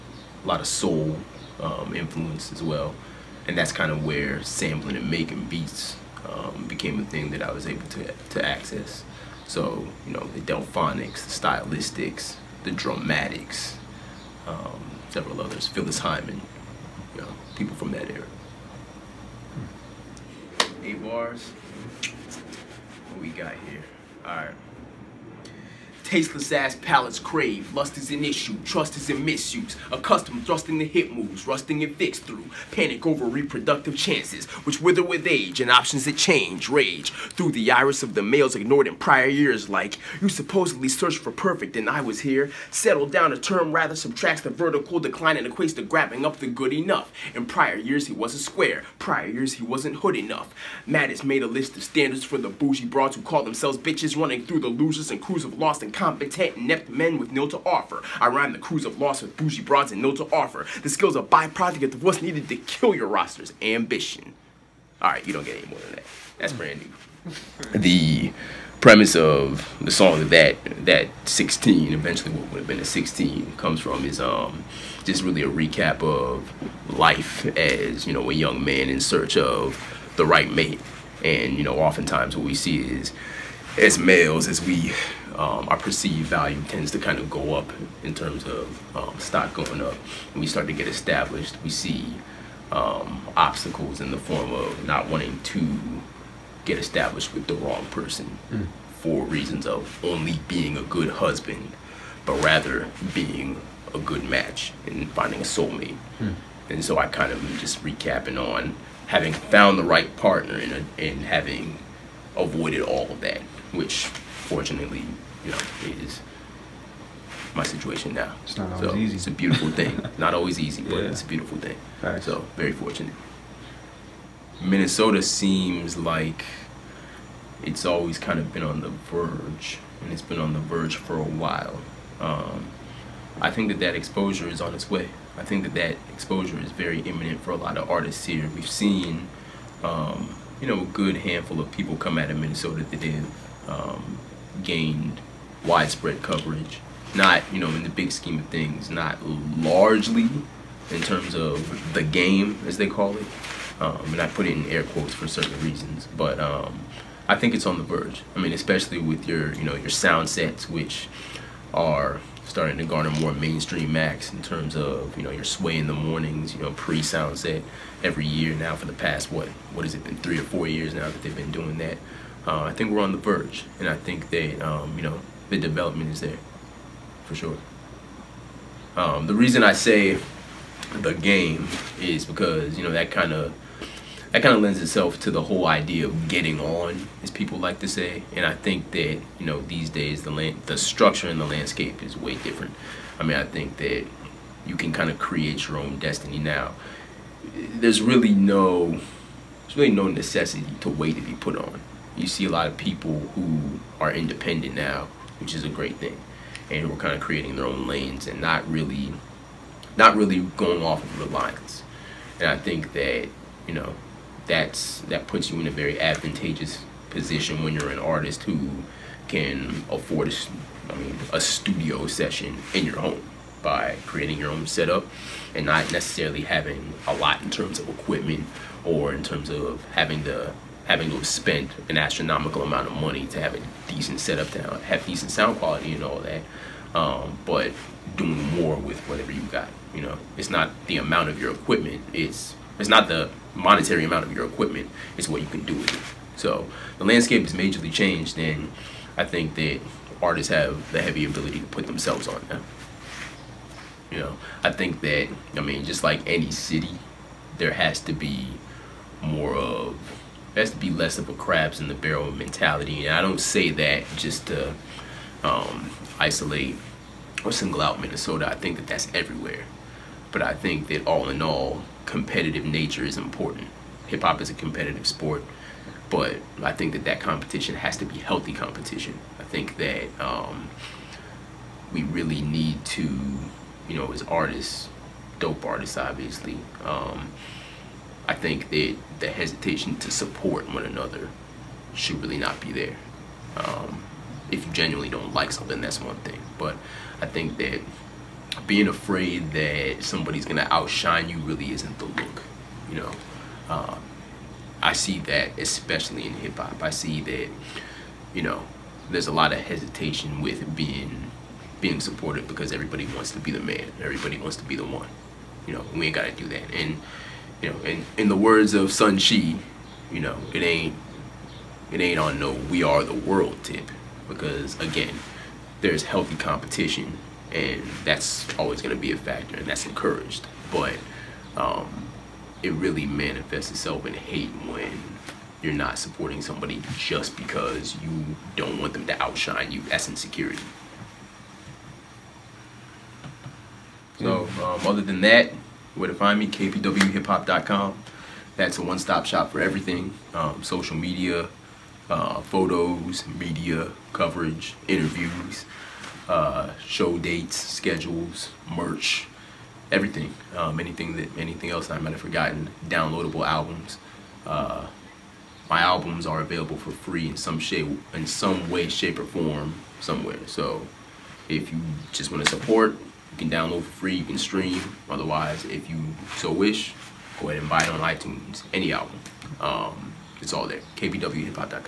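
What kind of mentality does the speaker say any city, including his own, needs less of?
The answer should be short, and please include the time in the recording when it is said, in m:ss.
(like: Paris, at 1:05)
Crabs in the barrel, at 4:21.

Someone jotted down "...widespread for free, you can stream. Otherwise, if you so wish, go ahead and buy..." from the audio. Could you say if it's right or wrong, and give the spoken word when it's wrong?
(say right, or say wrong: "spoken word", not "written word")
wrong: "download", not "widespread".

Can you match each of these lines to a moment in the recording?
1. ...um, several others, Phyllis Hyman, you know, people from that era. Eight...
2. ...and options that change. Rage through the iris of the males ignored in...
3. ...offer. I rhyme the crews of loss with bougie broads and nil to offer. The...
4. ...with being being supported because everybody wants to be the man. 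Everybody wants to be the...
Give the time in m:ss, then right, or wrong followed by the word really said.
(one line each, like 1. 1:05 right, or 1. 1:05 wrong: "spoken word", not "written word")
1. 0:14 right
2. 0:35 right
3. 0:57 right
4. 5:10 right.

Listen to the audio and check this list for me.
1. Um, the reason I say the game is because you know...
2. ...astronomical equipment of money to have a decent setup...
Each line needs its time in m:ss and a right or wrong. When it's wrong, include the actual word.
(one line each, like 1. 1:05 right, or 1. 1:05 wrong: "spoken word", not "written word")
1. 2:58 right
2. 3:51 wrong: "amount", not "equipment".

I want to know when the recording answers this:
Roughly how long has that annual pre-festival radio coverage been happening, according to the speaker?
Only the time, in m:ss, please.
2:50.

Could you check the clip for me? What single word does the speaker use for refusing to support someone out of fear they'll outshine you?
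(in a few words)
Insecurity.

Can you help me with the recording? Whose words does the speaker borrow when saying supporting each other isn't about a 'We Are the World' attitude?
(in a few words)
Sun Chi.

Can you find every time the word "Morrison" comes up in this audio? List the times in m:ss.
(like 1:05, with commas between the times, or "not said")
not said.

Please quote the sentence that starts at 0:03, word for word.
And that's kind of where sampling and making beats um, became a thing that I was able to, to access.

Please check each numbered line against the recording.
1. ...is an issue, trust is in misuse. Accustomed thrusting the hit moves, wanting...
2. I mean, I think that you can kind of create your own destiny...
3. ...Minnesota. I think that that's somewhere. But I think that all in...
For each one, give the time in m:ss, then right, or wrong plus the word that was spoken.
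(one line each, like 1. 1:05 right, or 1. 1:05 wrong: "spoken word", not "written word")
1. 0:27 wrong: "rusting", not "wanting"
2. 3:13 right
3. 4:27 wrong: "everywhere", not "somewhere".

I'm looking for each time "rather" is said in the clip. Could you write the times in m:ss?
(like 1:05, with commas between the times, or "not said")
0:43, 1:42.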